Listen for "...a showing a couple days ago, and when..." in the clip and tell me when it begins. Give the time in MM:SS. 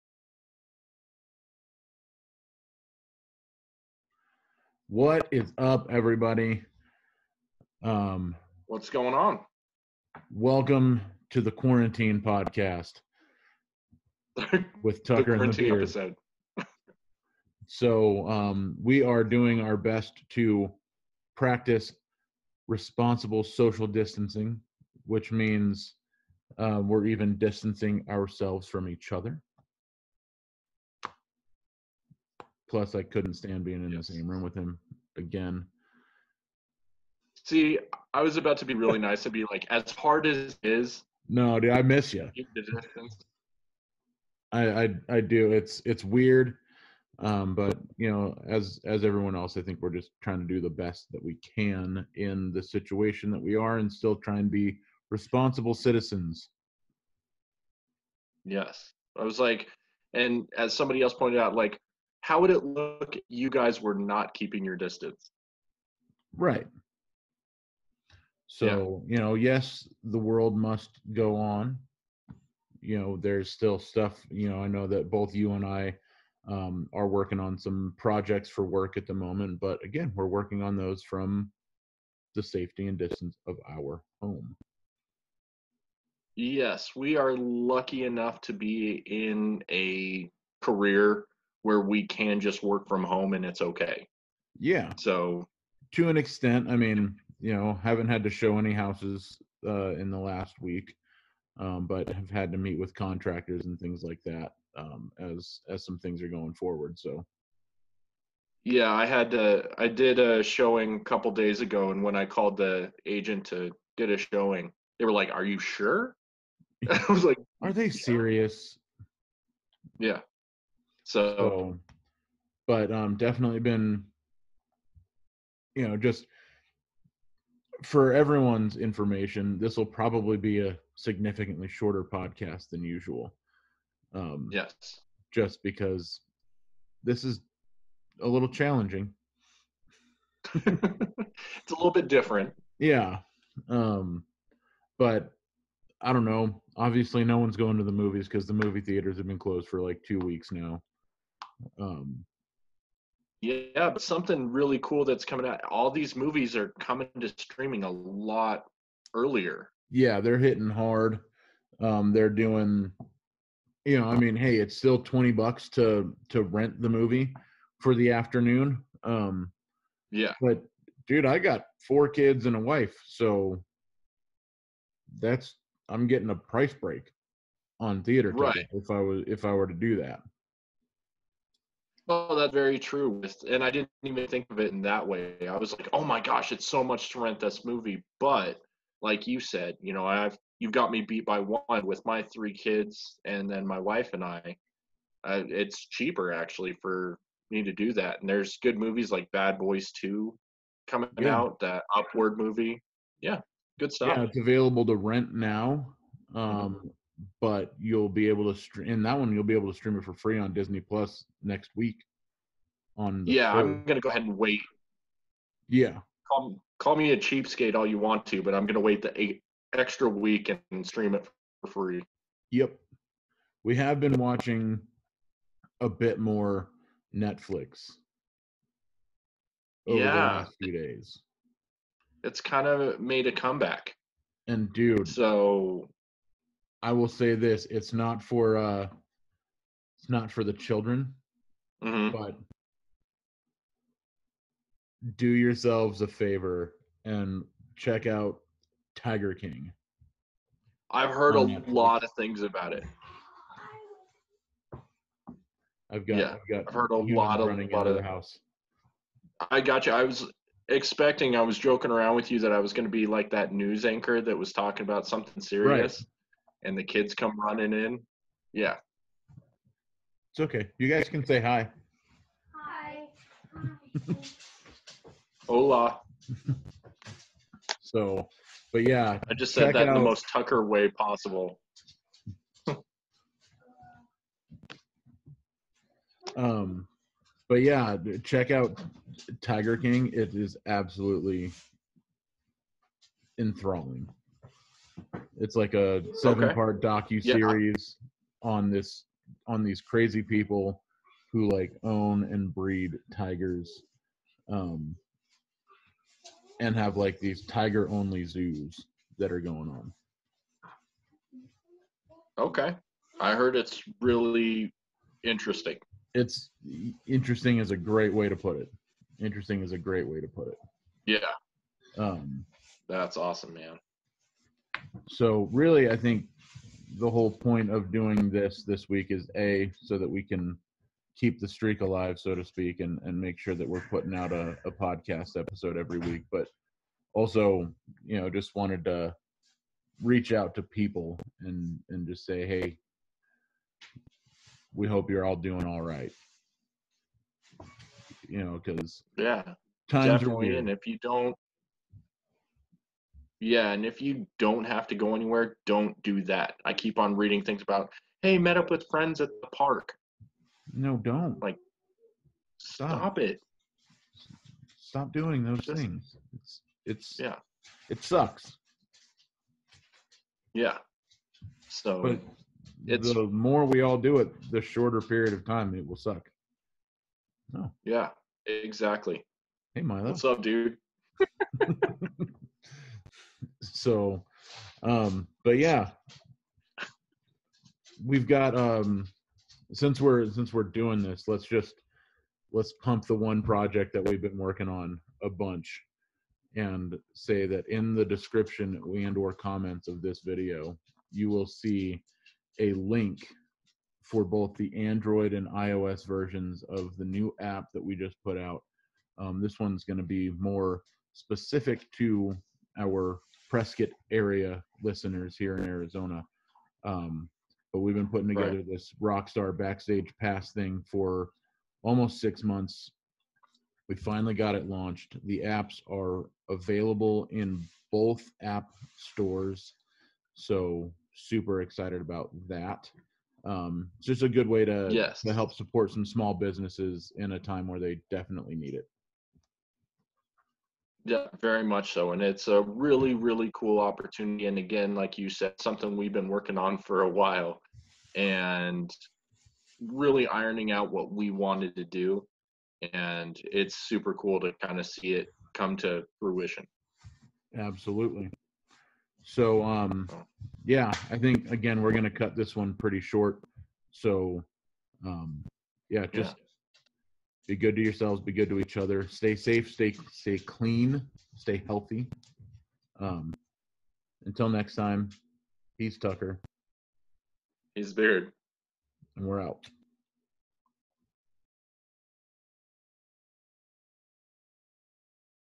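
01:50.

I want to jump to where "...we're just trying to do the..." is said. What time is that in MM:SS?
00:49.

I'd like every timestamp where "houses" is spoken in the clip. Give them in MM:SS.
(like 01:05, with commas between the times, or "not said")
01:38, 04:18.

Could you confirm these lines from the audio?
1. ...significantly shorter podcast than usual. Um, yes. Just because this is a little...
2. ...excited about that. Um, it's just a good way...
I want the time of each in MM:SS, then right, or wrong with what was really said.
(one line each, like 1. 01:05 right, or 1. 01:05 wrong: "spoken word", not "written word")
1. 02:10 right
2. 07:11 right.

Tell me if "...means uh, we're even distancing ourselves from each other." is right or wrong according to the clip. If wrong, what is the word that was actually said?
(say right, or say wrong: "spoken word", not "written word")
right.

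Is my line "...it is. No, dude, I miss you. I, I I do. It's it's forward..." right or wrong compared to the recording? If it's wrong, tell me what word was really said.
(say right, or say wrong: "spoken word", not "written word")
wrong: "weird", not "forward".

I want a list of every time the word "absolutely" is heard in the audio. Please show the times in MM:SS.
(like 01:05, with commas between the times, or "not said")
04:50, 07:37.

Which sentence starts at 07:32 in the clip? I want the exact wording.
And it's super cool to kind of see it come to fruition.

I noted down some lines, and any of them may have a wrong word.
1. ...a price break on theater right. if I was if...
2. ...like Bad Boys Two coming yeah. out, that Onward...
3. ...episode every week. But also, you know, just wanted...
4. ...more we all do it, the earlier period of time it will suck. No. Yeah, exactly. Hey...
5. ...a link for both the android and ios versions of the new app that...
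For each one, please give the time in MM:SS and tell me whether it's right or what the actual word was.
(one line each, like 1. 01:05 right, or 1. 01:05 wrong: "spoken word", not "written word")
1. 02:56 right
2. 03:19 right
3. 05:35 right
4. 06:13 wrong: "shorter", not "earlier"
5. 06:42 right.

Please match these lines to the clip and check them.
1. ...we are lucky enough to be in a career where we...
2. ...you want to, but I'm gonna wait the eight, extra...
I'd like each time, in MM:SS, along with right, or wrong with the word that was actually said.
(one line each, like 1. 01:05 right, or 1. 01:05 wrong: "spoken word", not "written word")
1. 01:26 right
2. 03:37 right.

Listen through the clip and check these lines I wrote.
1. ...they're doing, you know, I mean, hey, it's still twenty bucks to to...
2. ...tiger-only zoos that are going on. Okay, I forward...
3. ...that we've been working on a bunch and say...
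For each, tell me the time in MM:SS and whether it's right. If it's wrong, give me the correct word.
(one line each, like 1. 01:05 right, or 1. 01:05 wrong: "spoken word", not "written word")
1. 02:42 right
2. 05:07 wrong: "heard", not "forward"
3. 06:33 right.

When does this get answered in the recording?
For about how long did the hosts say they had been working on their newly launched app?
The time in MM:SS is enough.
07:02.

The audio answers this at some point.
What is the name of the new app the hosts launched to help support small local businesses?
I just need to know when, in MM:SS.
06:59.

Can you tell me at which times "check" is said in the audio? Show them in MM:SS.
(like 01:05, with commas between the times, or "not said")
04:07, 04:48.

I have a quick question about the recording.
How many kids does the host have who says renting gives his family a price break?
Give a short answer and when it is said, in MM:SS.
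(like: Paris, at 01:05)
4, at 02:51.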